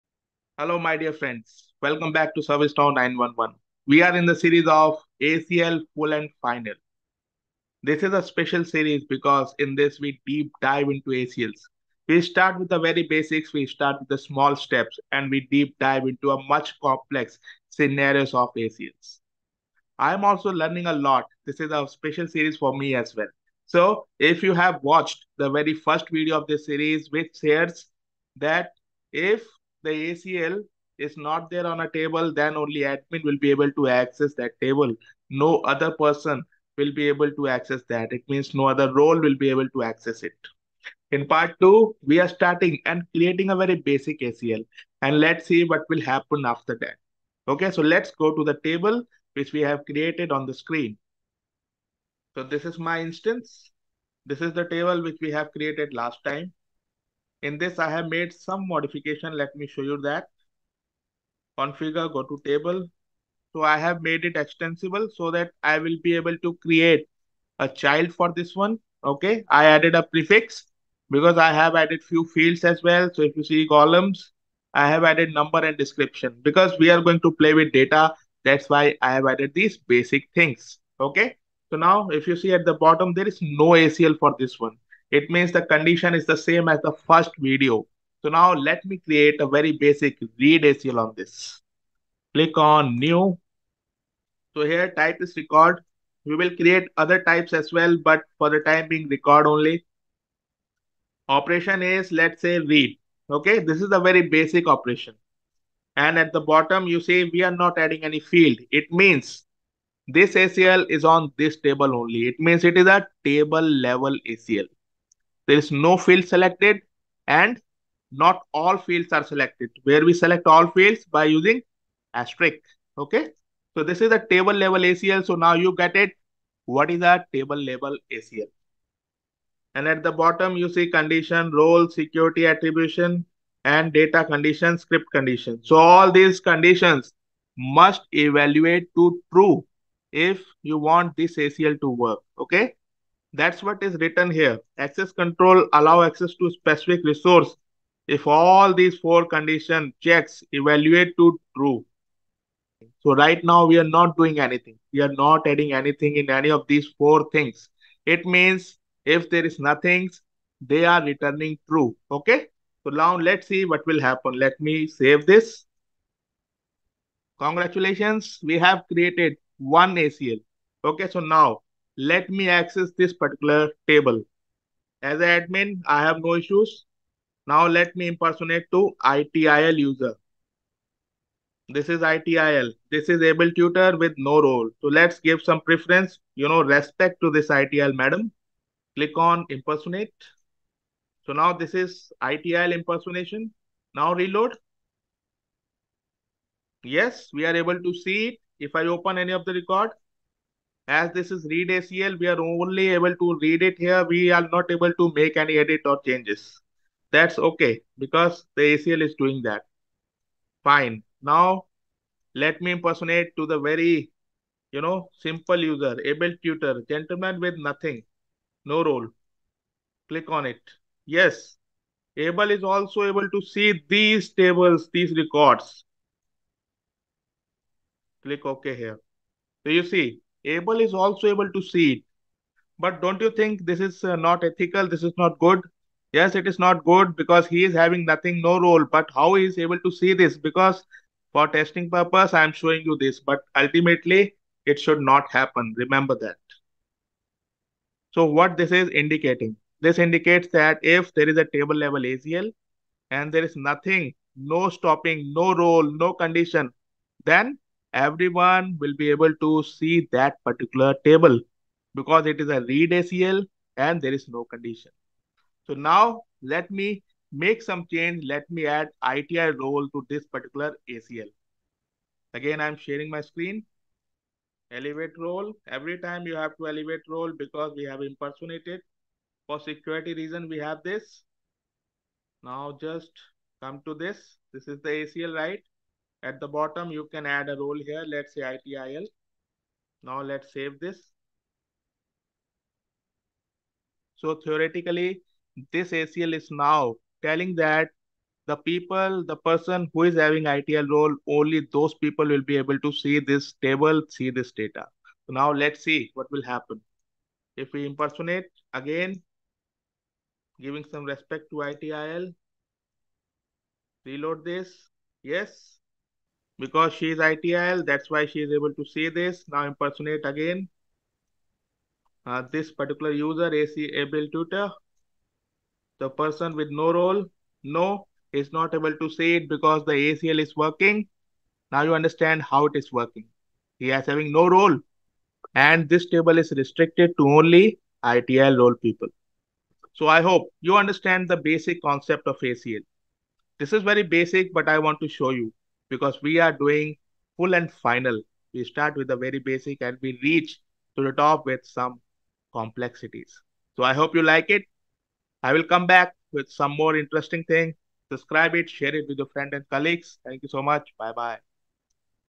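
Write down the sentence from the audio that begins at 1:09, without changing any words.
Okay, I added a prefix because I have added few fields as well.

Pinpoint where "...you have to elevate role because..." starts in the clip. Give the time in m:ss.
4:36.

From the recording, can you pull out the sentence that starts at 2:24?
Access control allow access to specific resource if all these four condition checks evaluate to true.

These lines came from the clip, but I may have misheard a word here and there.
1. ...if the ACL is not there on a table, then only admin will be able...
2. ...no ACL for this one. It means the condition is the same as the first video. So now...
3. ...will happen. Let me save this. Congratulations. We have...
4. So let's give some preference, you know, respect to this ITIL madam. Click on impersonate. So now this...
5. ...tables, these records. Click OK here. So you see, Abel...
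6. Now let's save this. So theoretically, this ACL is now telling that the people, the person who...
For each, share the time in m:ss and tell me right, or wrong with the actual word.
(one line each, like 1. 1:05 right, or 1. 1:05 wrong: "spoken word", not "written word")
1. 0:29 right
2. 1:23 right
3. 2:43 right
4. 3:04 right
5. 3:44 right
6. 4:50 right.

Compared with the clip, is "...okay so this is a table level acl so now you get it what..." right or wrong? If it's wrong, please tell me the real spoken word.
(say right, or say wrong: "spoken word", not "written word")
right.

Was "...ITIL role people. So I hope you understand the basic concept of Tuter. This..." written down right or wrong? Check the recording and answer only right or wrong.
wrong.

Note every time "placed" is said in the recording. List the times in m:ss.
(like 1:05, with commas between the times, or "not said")
not said.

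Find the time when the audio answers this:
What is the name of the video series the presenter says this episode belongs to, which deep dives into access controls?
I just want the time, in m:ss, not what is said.
0:05.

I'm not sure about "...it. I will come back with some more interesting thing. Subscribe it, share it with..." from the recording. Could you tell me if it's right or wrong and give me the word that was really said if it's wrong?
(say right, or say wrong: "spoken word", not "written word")
right.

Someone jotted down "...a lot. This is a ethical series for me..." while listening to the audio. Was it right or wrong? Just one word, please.
wrong.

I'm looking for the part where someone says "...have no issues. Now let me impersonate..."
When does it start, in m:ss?
2:56.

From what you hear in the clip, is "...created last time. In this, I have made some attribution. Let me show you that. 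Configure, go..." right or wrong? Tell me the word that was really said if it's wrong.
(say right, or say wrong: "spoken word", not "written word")
wrong: "modification", not "attribution".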